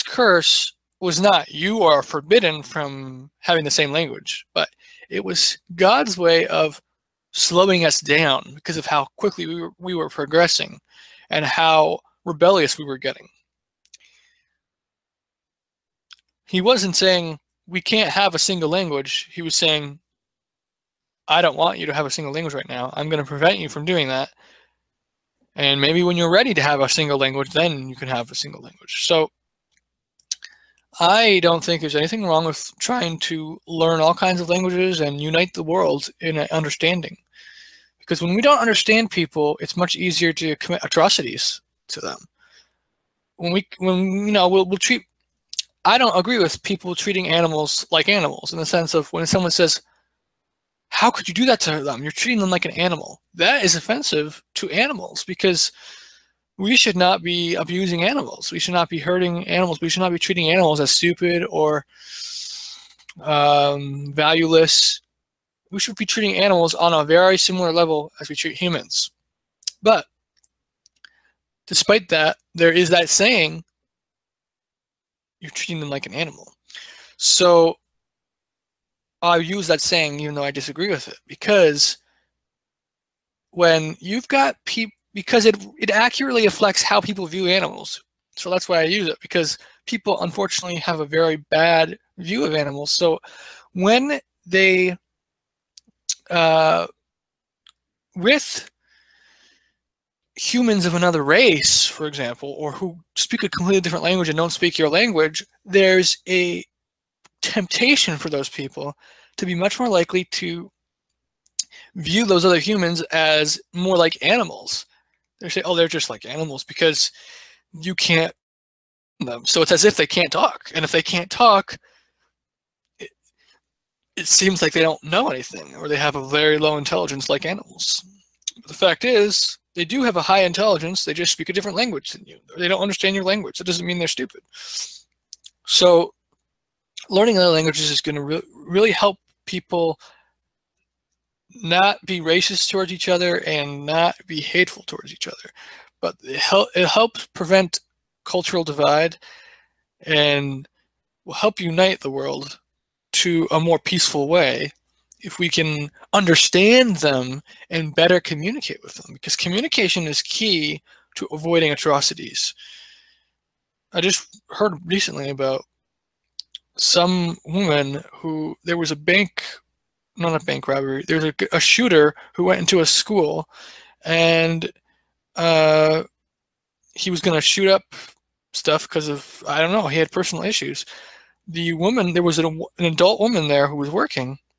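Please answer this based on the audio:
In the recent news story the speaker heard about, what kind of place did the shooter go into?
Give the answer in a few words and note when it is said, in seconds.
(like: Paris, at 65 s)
school, at 172 s.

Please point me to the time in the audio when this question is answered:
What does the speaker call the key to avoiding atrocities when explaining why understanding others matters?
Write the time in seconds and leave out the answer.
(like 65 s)
159 s.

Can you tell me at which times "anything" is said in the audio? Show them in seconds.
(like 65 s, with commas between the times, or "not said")
31 s, 125 s.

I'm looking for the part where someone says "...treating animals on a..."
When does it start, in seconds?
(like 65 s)
66 s.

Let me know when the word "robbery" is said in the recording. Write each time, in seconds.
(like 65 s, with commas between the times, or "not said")
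170 s.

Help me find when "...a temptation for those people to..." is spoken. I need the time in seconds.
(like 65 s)
106 s.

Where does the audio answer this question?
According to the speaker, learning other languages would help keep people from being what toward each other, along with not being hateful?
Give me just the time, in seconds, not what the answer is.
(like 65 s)
142 s.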